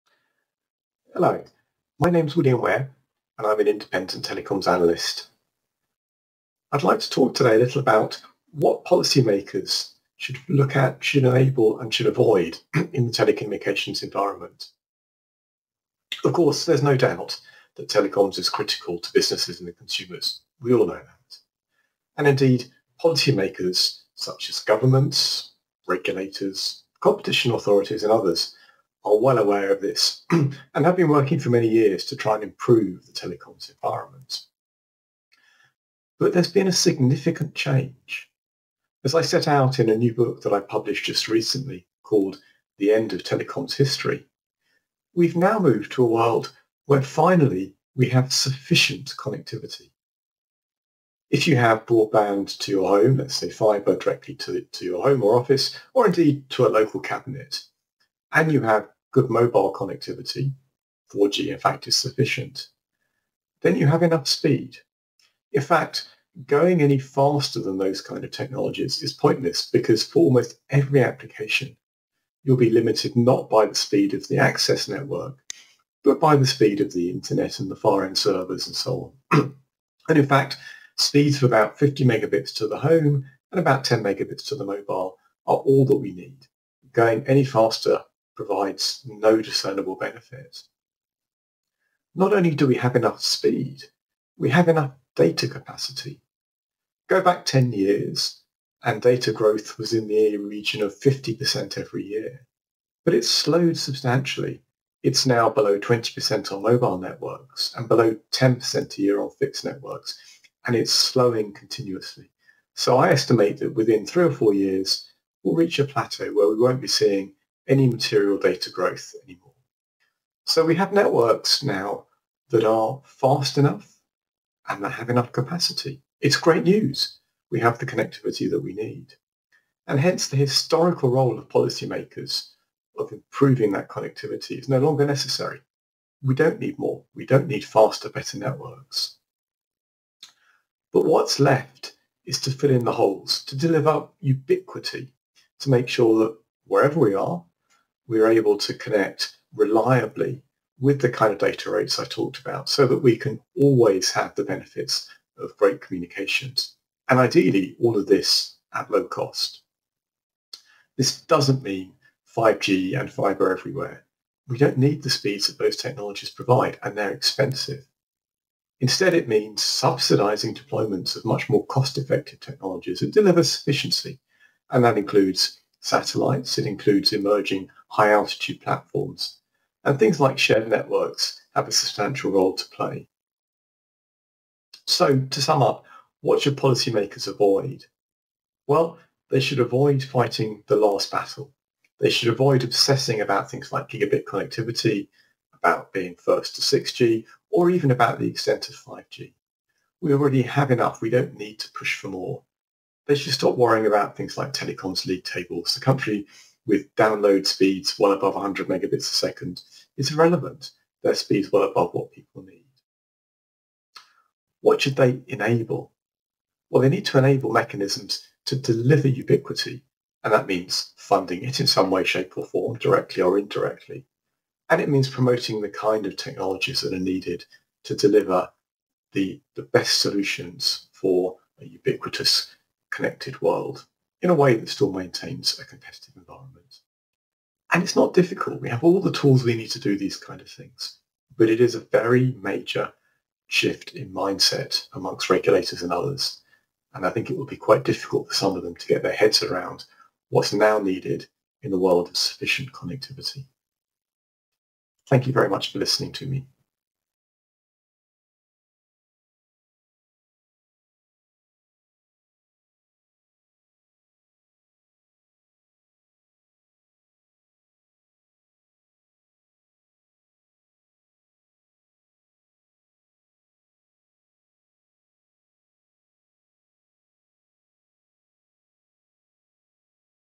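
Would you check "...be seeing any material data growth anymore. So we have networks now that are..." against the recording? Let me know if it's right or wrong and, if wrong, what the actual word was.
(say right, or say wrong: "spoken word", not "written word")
right.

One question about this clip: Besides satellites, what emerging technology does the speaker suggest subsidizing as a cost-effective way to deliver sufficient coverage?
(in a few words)
high altitude platforms.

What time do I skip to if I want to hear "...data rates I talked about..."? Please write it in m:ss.
2:31.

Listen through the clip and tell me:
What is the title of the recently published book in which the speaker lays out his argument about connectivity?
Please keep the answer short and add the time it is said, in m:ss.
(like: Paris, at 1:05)
The End of Telecoms History, at 0:42.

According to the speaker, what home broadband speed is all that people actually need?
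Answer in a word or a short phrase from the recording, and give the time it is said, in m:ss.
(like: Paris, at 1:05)
50 megabits, at 1:21.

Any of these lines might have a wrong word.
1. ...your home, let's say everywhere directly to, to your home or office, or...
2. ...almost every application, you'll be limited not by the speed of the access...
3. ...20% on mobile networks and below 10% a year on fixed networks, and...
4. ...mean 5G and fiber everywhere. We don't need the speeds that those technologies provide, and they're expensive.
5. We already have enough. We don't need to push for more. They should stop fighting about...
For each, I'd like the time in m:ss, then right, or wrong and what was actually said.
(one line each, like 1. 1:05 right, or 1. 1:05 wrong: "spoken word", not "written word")
1. 0:52 wrong: "fibre", not "everywhere"
2. 1:10 right
3. 1:45 right
4. 2:41 right
5. 3:19 wrong: "worrying", not "fighting".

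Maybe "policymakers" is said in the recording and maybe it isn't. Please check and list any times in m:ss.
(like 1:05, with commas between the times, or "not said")
0:08, 0:23, 2:11, 3:06.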